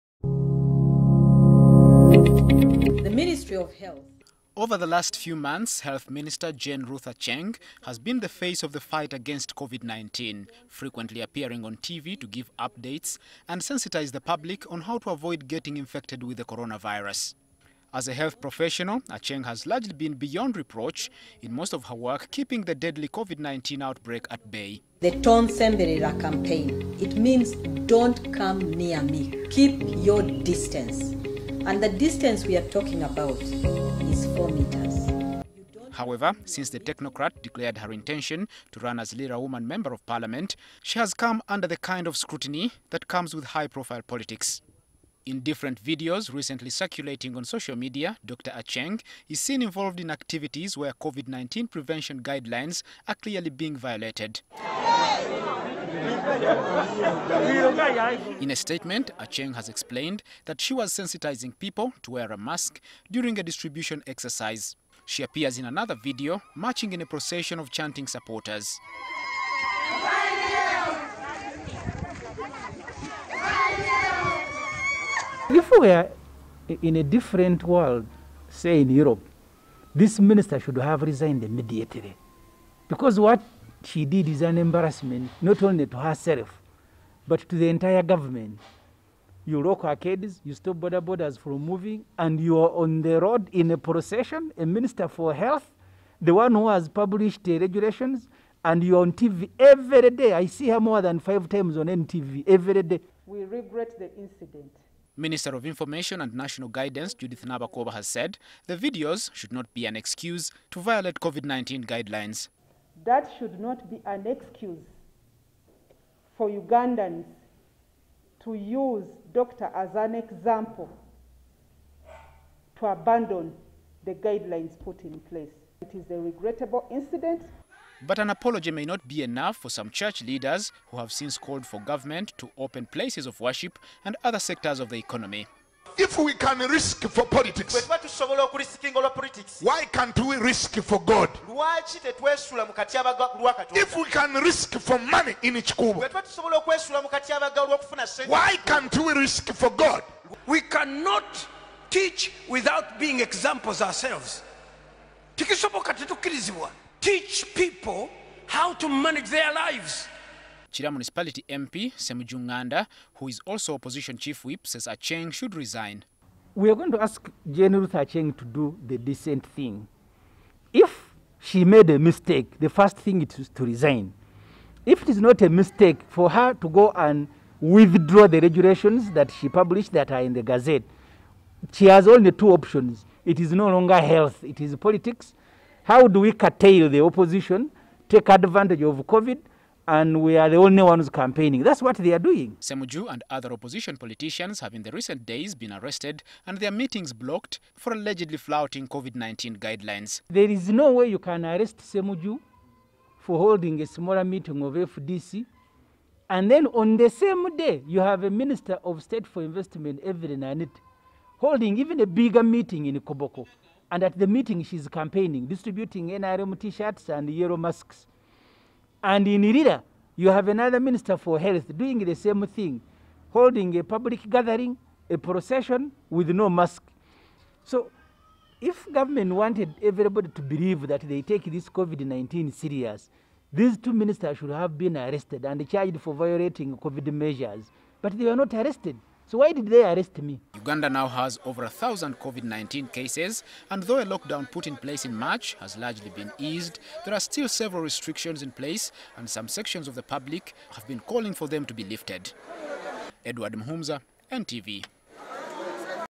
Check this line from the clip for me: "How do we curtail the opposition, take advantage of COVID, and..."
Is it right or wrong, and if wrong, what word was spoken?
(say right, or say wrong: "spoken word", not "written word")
right.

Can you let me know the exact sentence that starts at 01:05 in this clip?
She appears in another video, marching in a procession of chanting supporters.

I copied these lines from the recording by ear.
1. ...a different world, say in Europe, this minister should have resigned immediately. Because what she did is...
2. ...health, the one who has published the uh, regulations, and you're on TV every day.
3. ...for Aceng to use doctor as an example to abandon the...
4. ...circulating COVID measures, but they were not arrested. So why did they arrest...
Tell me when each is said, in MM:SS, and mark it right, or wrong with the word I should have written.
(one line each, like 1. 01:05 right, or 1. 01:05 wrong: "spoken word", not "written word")
1. 01:16 right
2. 01:35 right
3. 01:56 wrong: "Ugandans", not "Aceng"
4. 03:56 wrong: "violating", not "circulating".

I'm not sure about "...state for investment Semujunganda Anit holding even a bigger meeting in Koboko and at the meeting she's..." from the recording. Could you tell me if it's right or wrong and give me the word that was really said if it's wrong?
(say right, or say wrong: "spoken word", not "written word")
wrong: "Evelyn", not "Semujunganda".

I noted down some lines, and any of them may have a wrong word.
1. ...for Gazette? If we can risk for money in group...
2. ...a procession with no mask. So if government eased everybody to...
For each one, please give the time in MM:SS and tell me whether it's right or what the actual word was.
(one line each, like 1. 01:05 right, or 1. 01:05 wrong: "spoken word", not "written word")
1. 02:20 wrong: "God", not "Gazette"
2. 03:45 wrong: "wanted", not "eased".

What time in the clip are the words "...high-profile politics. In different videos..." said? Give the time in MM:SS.
00:43.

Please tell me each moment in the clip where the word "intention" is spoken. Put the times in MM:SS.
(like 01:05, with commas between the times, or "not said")
00:37.